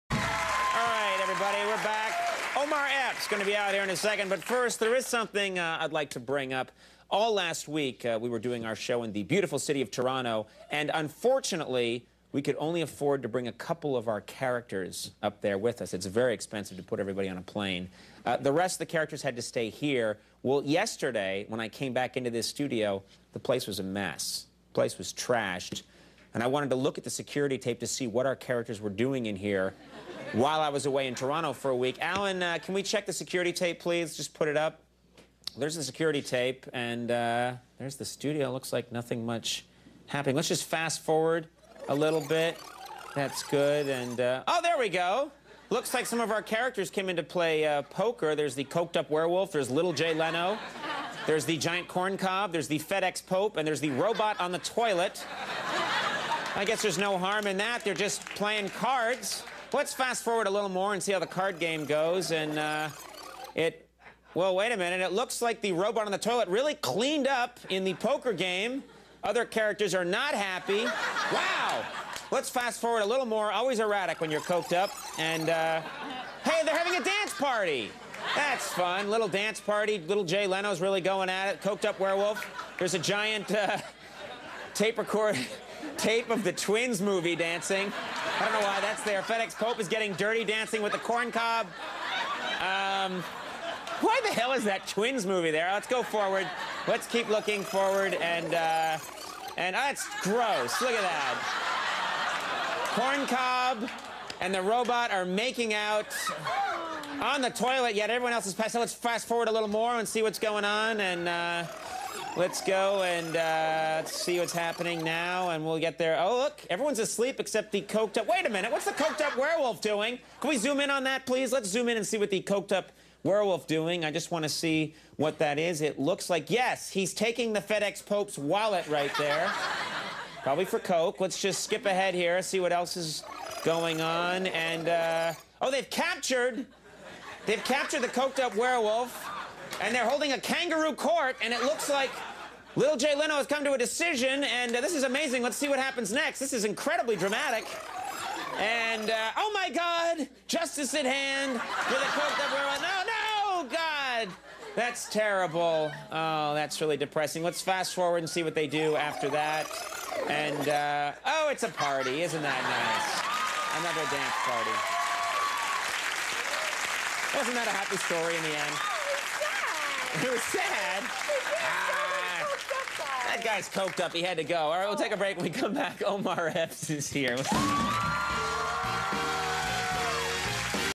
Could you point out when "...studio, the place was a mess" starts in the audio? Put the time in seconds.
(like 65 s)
22 s.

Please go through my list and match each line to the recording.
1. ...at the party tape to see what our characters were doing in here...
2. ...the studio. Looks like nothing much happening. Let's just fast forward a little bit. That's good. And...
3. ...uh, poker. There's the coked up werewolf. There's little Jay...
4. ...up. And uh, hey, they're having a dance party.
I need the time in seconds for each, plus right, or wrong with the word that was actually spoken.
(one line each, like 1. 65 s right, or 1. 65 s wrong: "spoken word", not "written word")
1. 26 s wrong: "security", not "party"
2. 37 s right
3. 47 s right
4. 74 s right.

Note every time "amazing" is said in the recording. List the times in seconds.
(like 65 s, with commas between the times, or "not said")
145 s.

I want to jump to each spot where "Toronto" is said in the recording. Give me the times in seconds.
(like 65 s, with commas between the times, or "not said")
9 s, 31 s.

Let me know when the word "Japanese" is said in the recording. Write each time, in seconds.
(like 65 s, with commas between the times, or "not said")
not said.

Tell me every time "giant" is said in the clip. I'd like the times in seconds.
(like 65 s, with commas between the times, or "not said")
51 s, 82 s.